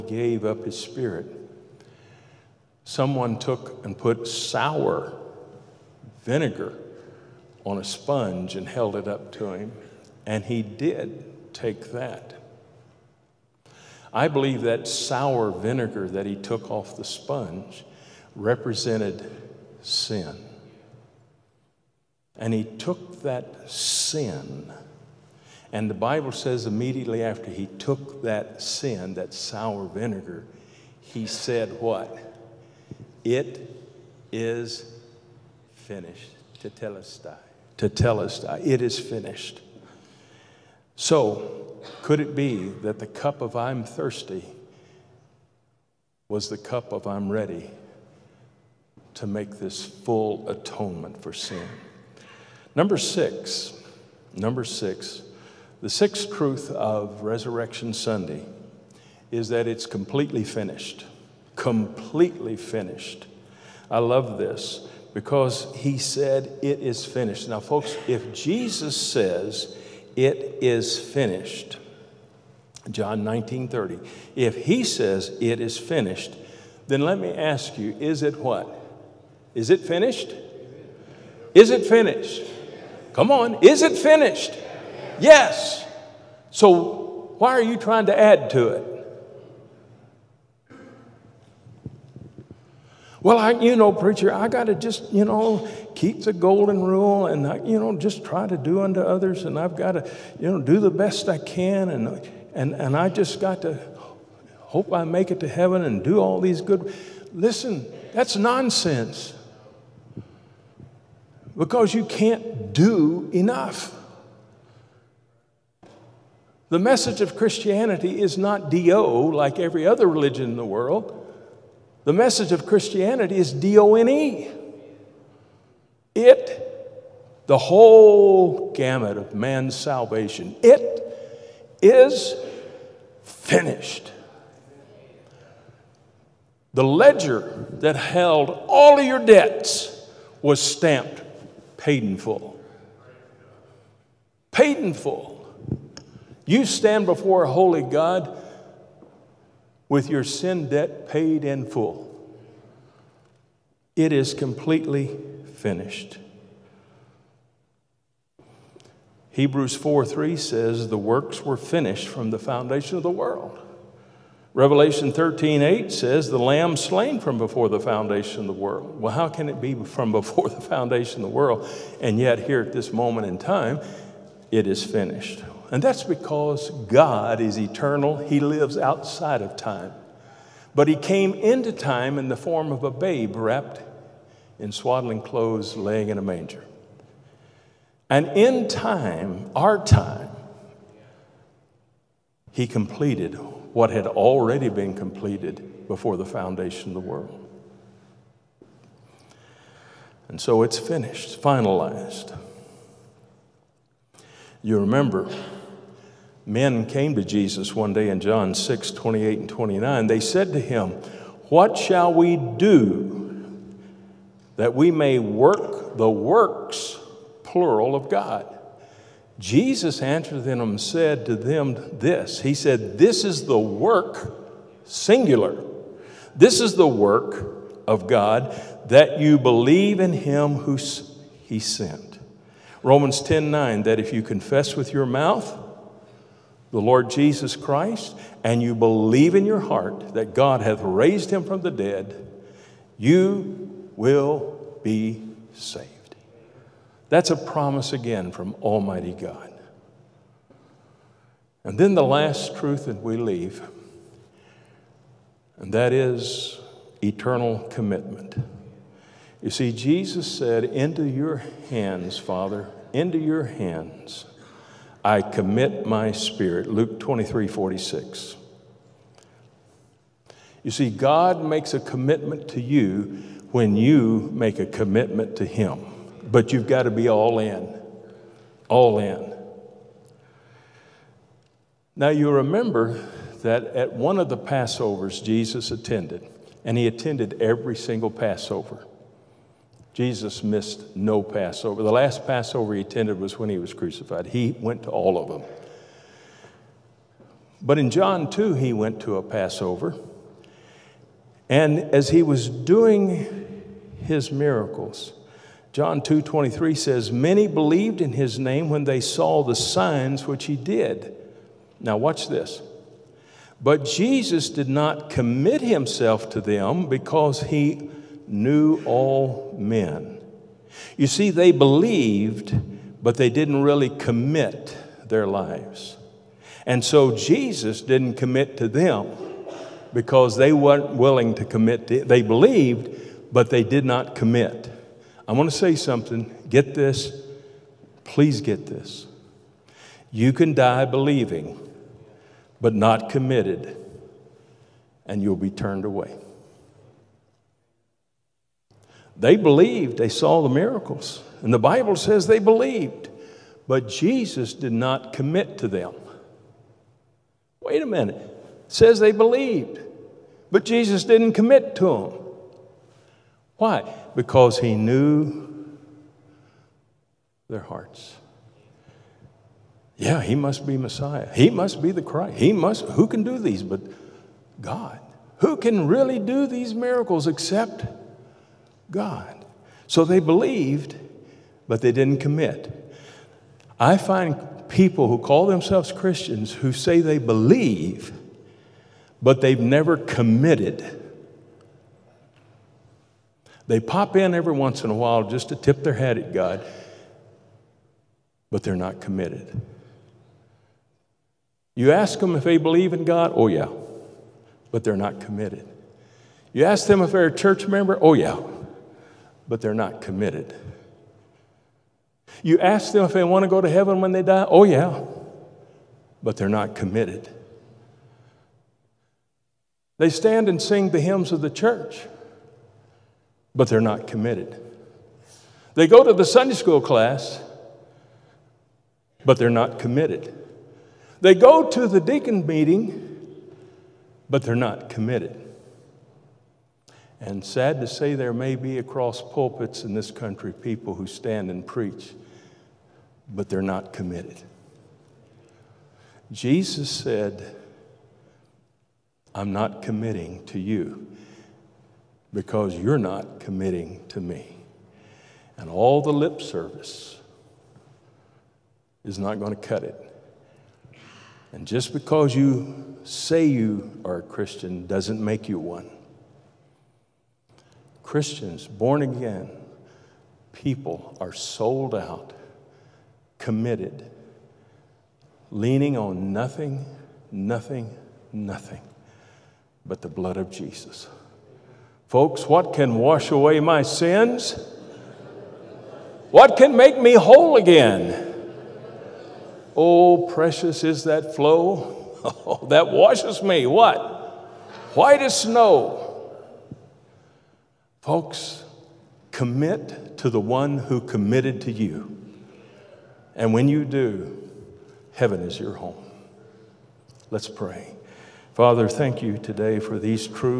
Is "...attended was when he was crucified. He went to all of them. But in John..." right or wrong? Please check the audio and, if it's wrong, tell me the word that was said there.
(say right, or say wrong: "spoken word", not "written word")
right.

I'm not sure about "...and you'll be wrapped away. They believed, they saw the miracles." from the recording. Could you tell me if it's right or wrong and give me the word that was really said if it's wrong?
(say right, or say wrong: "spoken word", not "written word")
wrong: "turned", not "wrapped".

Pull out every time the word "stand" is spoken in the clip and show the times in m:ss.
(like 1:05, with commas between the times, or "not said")
2:26, 7:00, 7:21.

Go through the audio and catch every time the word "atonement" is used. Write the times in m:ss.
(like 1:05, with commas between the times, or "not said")
0:50.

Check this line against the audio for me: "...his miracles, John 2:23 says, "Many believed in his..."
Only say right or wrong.
right.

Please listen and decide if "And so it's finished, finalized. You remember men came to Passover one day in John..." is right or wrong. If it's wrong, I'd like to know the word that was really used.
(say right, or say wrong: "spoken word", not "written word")
wrong: "Jesus", not "Passover".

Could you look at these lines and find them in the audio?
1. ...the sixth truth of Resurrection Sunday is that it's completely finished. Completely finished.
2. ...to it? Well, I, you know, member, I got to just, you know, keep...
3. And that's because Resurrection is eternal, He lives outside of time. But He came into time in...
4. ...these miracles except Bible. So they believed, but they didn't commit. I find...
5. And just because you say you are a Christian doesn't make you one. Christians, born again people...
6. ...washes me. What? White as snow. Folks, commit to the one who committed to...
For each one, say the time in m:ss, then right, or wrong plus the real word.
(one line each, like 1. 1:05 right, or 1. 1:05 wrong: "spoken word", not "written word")
1. 0:55 right
2. 1:28 wrong: "preacher", not "member"
3. 2:55 wrong: "God", not "Resurrection"
4. 6:16 wrong: "God", not "Bible"
5. 7:41 right
6. 8:12 right.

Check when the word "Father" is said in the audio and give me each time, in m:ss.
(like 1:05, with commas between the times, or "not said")
4:22, 8:28.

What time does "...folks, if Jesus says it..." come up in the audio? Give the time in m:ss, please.
1:07.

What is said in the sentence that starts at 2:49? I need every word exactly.
Well, how can it be from before the foundation of the world?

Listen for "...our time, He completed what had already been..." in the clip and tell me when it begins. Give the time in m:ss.
3:09.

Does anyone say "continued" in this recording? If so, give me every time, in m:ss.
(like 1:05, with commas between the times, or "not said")
not said.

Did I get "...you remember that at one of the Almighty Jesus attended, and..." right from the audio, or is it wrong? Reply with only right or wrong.
wrong.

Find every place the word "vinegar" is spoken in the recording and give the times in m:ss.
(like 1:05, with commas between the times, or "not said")
0:06, 0:15, 0:29.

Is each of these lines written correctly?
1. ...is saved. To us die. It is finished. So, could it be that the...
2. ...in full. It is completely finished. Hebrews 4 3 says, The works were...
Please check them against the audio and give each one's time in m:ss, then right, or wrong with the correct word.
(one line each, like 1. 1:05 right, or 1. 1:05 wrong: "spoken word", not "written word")
1. 0:34 wrong: "finished", not "saved"
2. 2:31 right.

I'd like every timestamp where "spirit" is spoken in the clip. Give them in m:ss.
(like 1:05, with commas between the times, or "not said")
0:00, 4:26.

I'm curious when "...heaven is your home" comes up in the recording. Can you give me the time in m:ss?
8:25.